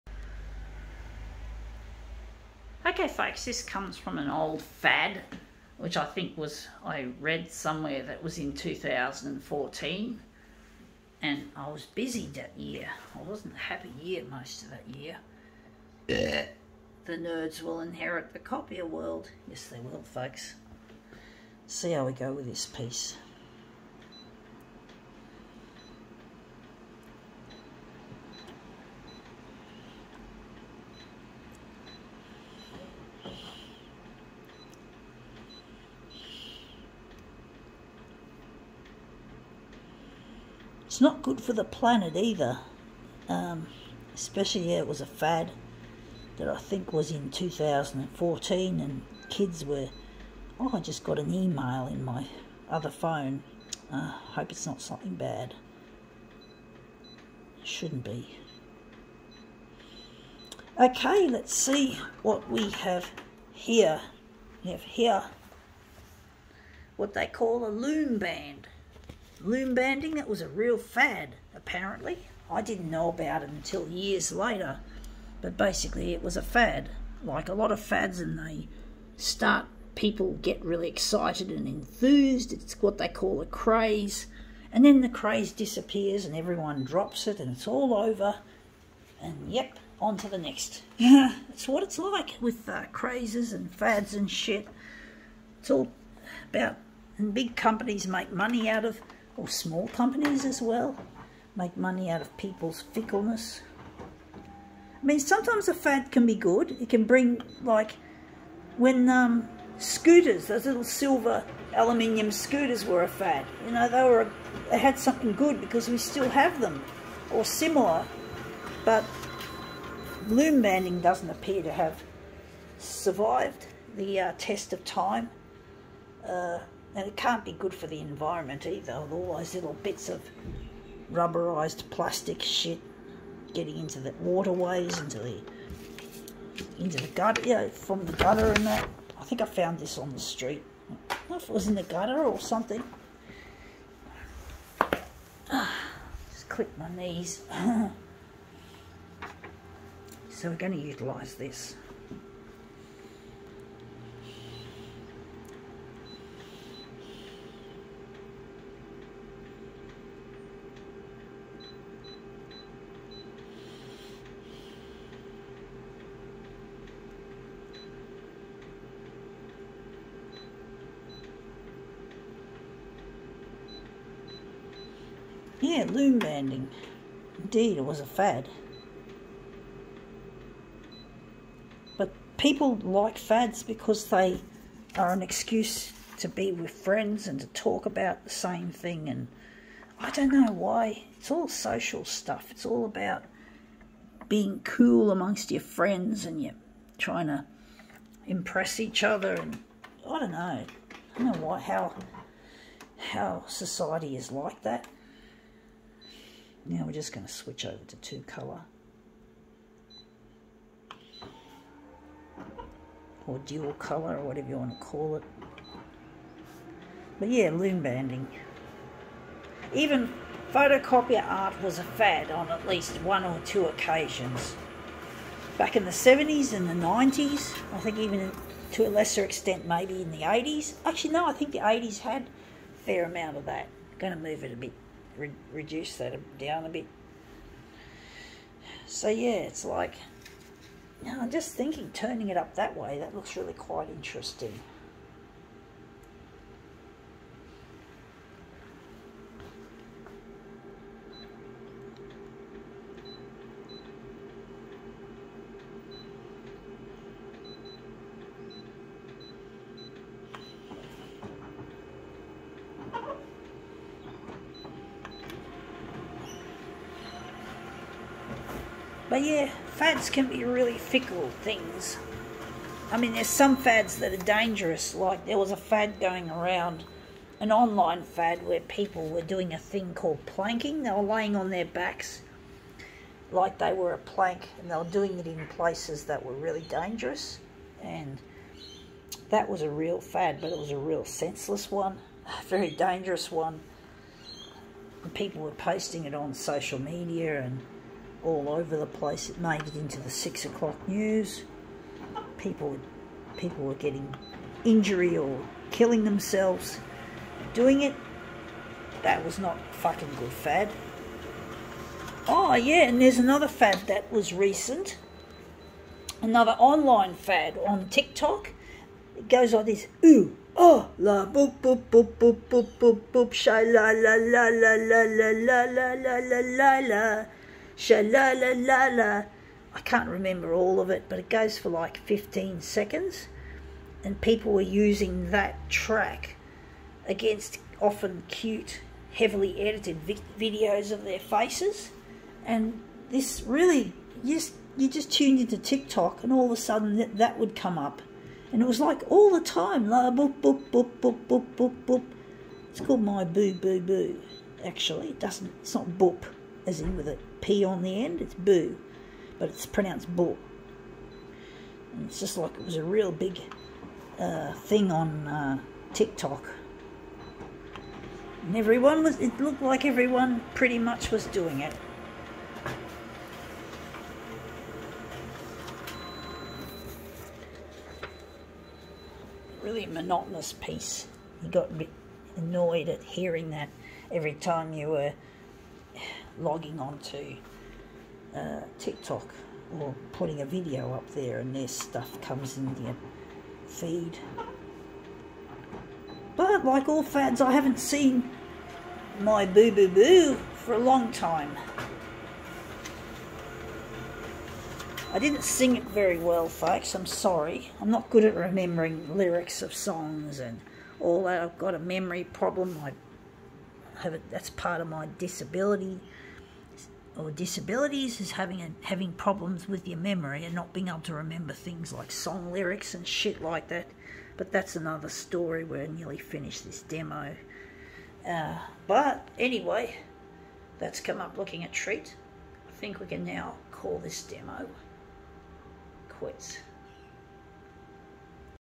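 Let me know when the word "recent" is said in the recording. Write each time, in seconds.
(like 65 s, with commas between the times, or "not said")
314 s.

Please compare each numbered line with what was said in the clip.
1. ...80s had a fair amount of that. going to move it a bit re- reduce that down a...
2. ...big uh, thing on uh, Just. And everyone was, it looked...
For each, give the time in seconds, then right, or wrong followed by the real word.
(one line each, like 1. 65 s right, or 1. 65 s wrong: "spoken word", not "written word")
1. 231 s right
2. 363 s wrong: "TikTok", not "Just".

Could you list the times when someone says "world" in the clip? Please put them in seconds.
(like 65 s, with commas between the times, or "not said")
18 s.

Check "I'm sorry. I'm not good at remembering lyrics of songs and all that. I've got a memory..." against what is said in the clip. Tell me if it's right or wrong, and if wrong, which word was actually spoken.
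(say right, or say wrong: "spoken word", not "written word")
right.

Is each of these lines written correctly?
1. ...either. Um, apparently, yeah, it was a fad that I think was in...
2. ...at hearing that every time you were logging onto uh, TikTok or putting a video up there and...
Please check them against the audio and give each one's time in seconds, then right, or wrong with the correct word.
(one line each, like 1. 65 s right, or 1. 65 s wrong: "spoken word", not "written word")
1. 42 s wrong: "especially", not "apparently"
2. 382 s right.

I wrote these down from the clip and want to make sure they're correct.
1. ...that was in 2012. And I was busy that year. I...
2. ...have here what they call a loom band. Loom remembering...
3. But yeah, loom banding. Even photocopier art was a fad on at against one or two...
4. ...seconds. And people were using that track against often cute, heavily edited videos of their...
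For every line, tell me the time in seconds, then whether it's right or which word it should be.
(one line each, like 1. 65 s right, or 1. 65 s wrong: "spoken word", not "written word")
1. 8 s wrong: "2014", not "2012"
2. 64 s wrong: "banding", not "remembering"
3. 217 s wrong: "least", not "against"
4. 332 s right.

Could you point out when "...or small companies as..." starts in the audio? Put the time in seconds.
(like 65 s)
99 s.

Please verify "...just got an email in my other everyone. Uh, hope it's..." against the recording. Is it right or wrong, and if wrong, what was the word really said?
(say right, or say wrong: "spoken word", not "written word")
wrong: "phone", not "everyone".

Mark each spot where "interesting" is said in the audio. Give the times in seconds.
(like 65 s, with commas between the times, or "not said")
243 s.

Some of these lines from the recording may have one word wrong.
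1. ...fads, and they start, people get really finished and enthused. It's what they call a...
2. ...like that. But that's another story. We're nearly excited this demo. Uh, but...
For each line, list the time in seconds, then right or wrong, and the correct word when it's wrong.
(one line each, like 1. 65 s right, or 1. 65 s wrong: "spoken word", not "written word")
1. 77 s wrong: "excited", not "finished"
2. 423 s wrong: "finished", not "excited".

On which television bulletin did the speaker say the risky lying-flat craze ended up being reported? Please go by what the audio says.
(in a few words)
six o'clock news.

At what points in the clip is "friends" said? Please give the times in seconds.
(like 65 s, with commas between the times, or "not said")
186 s, 195 s.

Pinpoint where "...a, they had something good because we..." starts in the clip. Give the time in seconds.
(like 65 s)
114 s.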